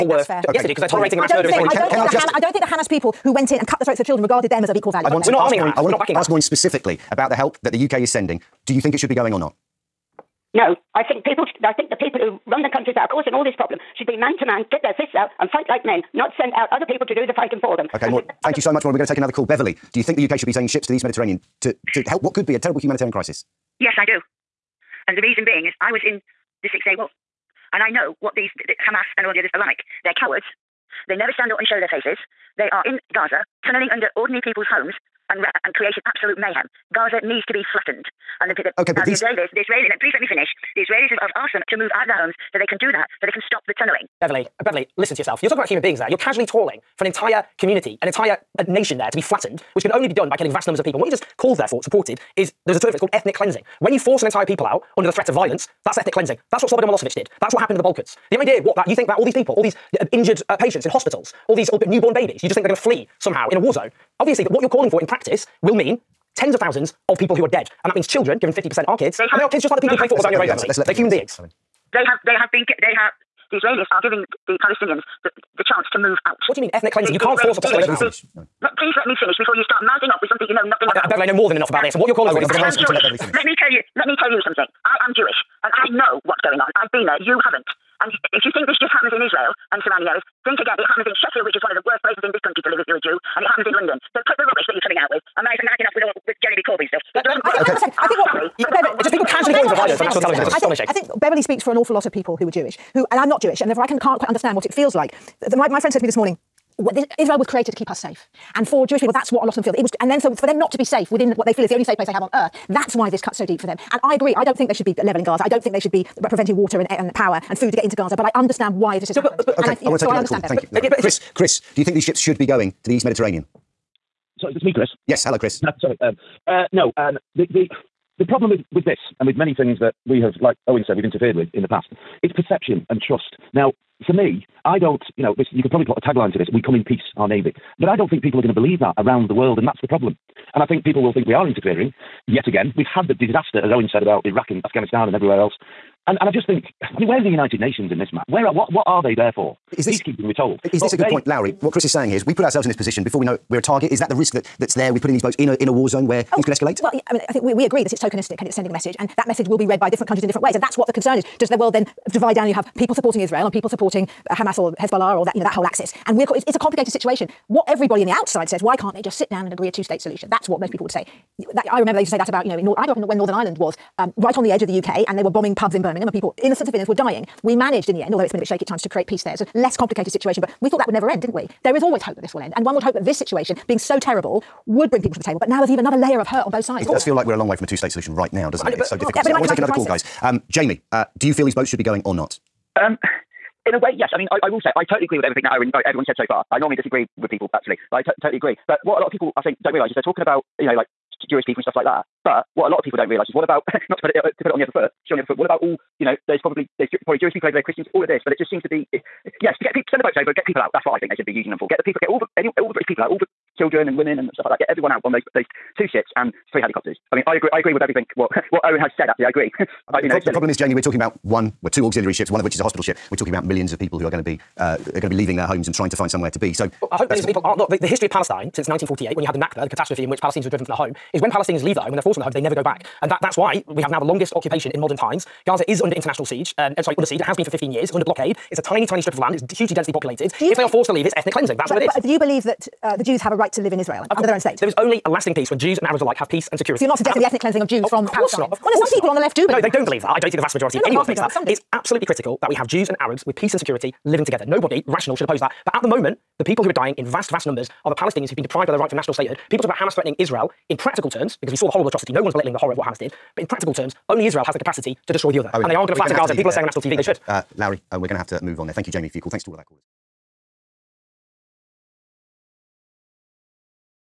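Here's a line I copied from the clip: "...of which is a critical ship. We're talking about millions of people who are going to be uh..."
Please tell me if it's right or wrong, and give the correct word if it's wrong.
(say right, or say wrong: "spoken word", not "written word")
wrong: "hospital", not "critical".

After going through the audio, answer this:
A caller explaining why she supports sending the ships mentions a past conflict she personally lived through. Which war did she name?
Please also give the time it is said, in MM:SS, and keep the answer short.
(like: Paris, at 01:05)
Six Day War, at 00:26.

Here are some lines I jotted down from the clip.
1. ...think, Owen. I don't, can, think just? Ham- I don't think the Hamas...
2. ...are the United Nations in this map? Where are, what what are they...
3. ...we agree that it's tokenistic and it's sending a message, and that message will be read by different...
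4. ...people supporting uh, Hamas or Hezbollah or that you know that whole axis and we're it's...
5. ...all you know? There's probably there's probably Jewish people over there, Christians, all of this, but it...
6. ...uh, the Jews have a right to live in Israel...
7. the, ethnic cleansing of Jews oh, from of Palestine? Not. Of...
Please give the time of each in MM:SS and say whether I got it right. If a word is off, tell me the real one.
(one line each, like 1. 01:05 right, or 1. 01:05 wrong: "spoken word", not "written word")
1. 00:01 wrong: "Israeli", not "Owen"
2. 02:27 right
3. 02:37 right
4. 02:43 right
5. 03:25 right
6. 04:02 right
7. 04:07 right.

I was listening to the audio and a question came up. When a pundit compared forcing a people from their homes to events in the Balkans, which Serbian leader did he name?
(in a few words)
Slobodan Milosevic.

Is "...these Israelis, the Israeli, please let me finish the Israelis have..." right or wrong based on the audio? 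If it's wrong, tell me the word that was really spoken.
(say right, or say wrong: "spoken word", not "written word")
right.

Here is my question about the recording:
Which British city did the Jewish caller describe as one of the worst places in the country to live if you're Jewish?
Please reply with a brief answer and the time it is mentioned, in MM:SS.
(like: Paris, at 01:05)
Sheffield, at 01:31.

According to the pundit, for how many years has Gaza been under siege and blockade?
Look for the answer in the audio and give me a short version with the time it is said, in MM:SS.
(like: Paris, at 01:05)
15 years, at 03:57.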